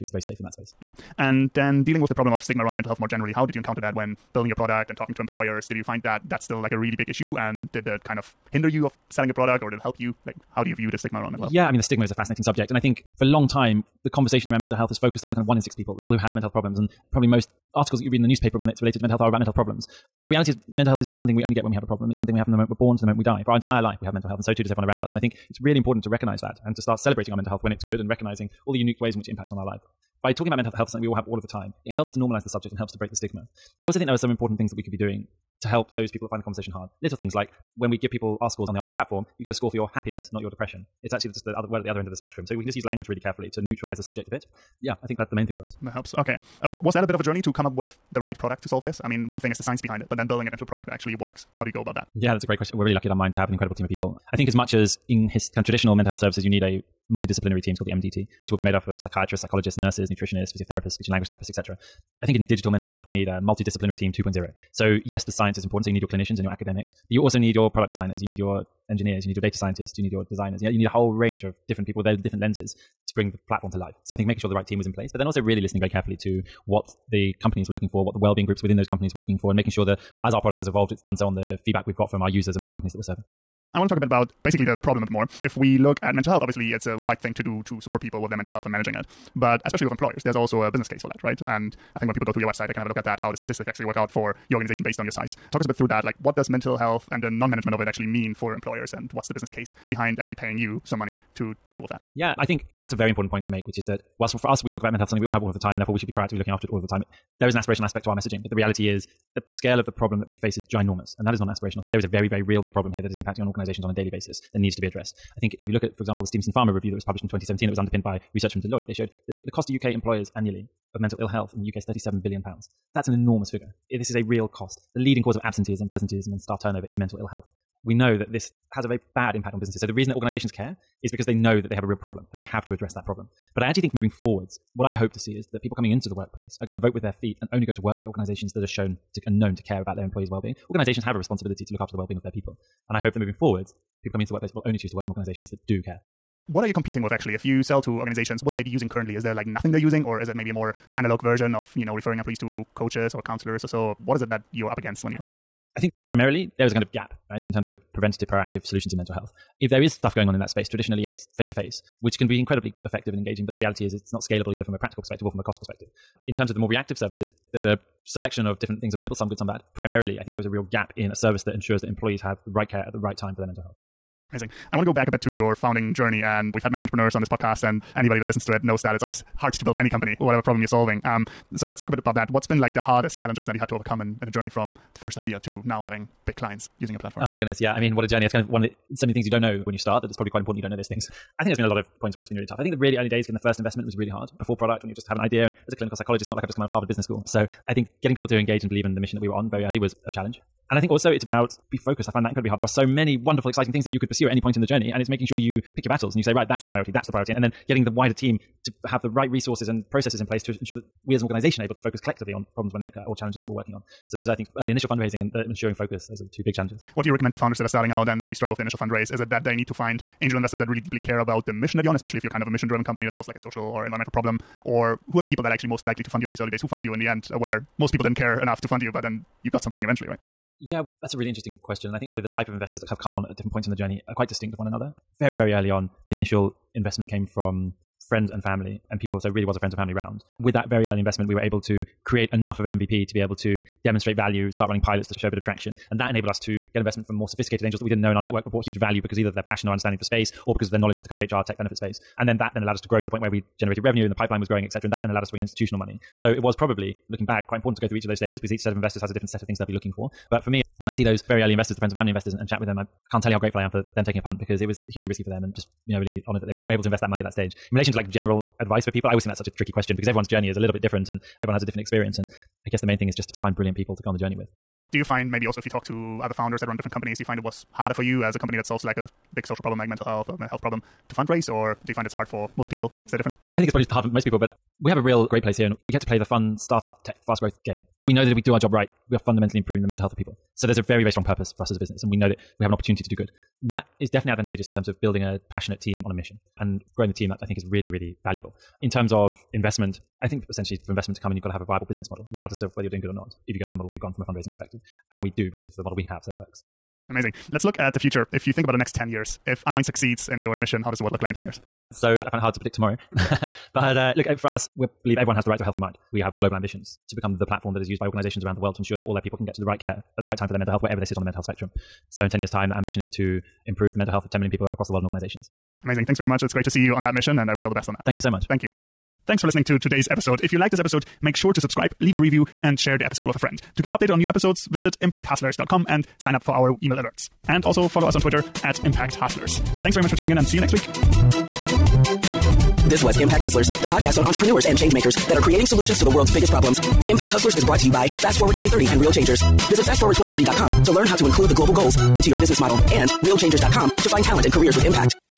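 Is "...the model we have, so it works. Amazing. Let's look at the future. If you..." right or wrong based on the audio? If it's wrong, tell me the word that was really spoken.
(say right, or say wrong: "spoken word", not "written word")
right.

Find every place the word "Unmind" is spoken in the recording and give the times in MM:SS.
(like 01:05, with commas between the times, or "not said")
00:53, 05:09.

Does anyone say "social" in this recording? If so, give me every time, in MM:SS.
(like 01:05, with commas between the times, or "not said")
03:43, 04:39.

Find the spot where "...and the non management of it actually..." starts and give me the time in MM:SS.
01:37.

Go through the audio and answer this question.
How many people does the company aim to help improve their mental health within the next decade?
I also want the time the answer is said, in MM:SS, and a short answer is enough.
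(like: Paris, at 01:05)
10 million, at 05:24.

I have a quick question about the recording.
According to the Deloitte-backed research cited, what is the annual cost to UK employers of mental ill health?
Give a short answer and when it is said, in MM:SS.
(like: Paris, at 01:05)
37 billion pounds, at 02:01.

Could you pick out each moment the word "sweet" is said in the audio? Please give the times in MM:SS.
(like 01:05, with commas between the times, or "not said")
not said.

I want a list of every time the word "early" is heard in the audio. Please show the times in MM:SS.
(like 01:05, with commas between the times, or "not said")
03:12, 03:19, 03:34, 03:46, 03:55, 04:00, 04:21.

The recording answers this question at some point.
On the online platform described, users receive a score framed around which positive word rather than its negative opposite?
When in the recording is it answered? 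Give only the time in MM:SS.
00:39.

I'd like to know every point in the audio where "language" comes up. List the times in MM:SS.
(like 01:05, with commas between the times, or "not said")
00:42, 01:01.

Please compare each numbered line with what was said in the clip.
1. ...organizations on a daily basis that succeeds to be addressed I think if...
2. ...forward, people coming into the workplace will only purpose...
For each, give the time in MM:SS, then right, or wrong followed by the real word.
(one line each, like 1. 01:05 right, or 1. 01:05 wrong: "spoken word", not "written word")
1. 01:53 wrong: "needs", not "succeeds"
2. 02:23 wrong: "choose", not "purpose".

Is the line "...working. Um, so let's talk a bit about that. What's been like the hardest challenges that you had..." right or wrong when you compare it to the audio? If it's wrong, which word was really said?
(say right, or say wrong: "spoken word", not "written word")
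wrong: "solving", not "working".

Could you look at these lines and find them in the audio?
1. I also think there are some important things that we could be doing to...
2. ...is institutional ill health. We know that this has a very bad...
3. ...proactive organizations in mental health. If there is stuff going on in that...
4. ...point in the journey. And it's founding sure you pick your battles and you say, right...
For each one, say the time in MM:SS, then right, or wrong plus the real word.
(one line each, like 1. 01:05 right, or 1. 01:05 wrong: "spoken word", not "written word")
1. 00:33 right
2. 02:06 wrong: "mental", not "institutional"
3. 02:38 wrong: "solutions", not "organizations"
4. 03:24 wrong: "making", not "founding".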